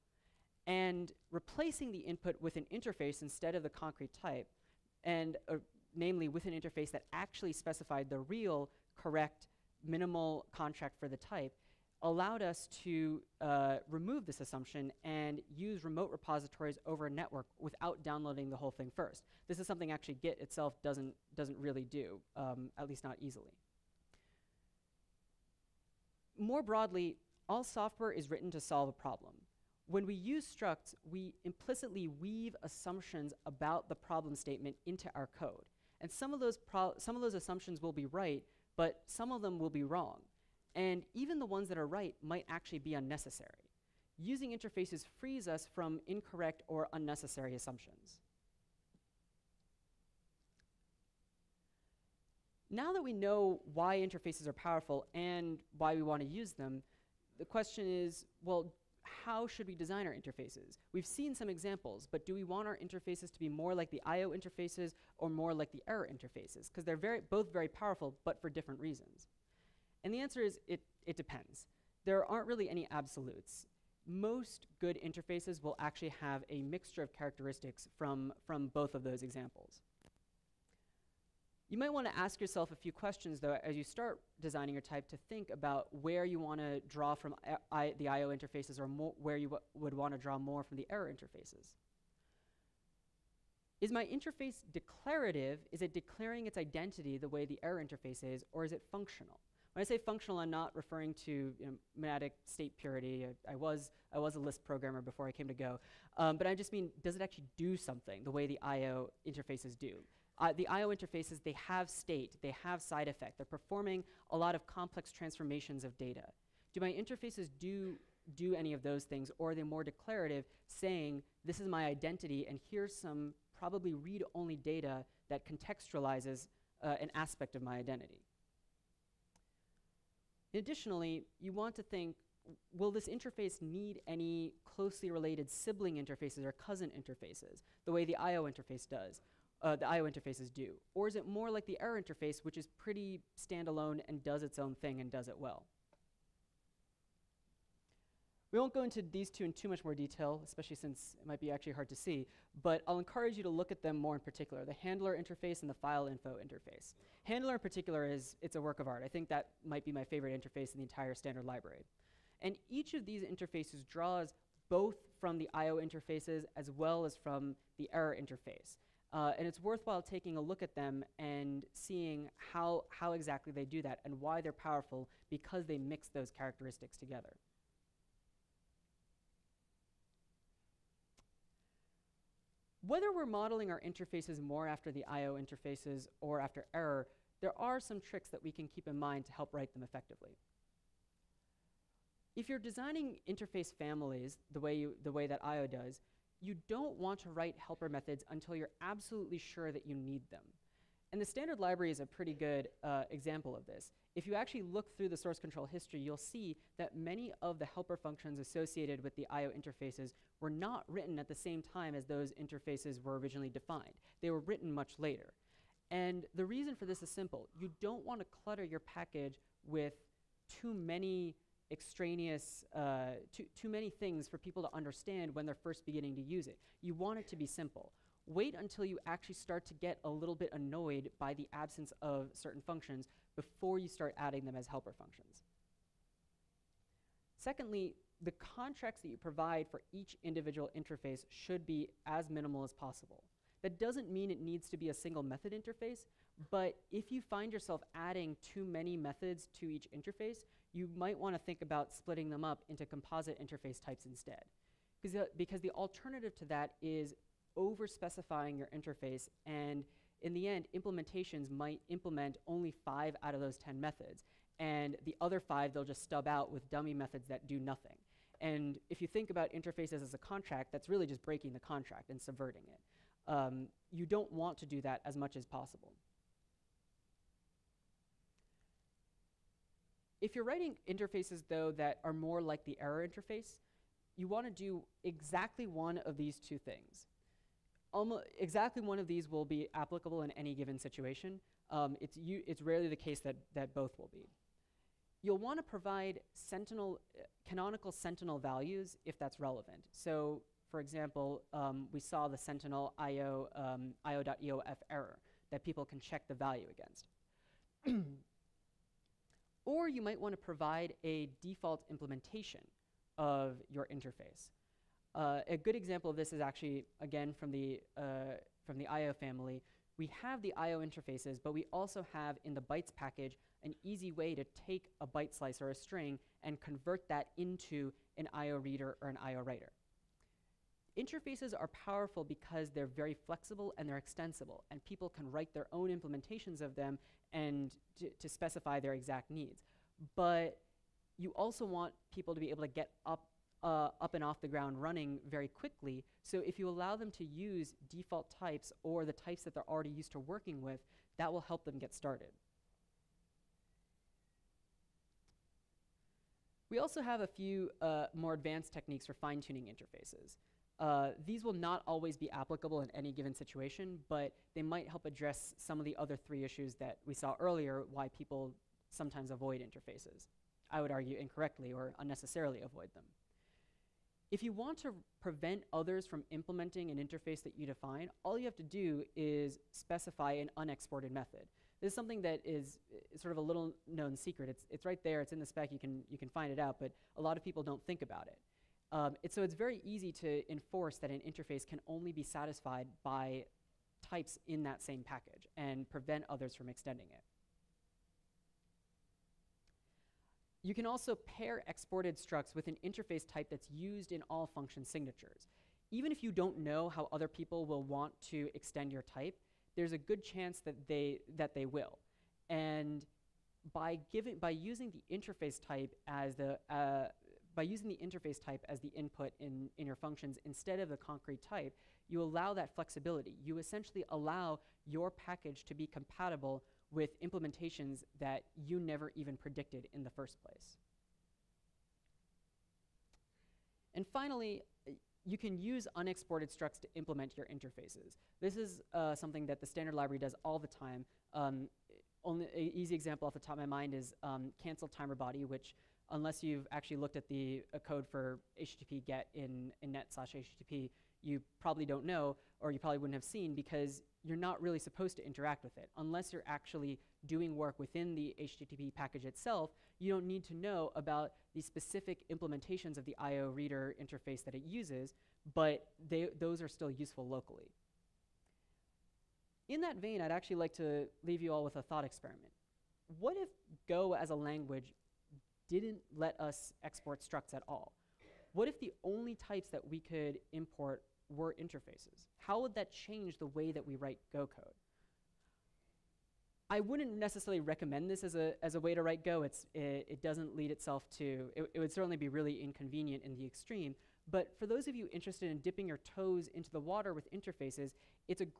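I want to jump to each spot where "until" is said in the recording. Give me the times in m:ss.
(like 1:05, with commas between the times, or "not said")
3:18, 3:48.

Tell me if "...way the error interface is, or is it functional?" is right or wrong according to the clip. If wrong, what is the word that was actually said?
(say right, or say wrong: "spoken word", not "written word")
right.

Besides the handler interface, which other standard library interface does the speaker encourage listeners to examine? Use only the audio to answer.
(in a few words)
file info interface.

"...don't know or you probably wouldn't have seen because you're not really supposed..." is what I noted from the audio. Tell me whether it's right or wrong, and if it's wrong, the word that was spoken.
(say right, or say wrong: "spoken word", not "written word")
right.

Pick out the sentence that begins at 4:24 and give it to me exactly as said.
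And the other five, they'll just stub out with dummy methods that do nothing.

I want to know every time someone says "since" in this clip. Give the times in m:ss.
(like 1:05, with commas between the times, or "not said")
2:30.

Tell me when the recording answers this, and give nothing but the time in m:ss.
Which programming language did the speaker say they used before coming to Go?
1:44.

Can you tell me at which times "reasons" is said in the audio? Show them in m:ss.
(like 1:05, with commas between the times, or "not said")
1:08, 3:36.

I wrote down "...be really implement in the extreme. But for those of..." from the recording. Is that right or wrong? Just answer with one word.
wrong.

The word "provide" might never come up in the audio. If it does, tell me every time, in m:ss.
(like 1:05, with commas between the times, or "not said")
3:59, 4:55, 5:10.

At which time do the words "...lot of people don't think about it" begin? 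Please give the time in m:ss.
6:27.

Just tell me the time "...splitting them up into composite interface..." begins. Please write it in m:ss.
4:11.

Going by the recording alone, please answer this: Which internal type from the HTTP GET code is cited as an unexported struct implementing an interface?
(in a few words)
cancel timer body.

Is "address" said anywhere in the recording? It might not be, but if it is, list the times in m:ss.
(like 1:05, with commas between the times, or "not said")
6:05.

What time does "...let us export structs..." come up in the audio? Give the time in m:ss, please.
7:56.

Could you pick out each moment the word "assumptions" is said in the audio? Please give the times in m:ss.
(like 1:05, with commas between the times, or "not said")
0:14, 0:32, 0:37, 0:47.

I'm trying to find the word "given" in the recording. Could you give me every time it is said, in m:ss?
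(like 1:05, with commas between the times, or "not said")
4:50, 6:03.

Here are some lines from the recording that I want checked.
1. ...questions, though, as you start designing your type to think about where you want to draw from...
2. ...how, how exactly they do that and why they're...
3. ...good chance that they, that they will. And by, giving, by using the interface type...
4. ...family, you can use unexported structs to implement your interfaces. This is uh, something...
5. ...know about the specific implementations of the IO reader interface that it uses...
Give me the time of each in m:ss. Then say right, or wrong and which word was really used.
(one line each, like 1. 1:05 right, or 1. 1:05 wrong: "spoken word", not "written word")
1. 1:22 right
2. 2:52 right
3. 6:49 right
4. 7:14 wrong: "finally", not "family"
5. 7:40 right.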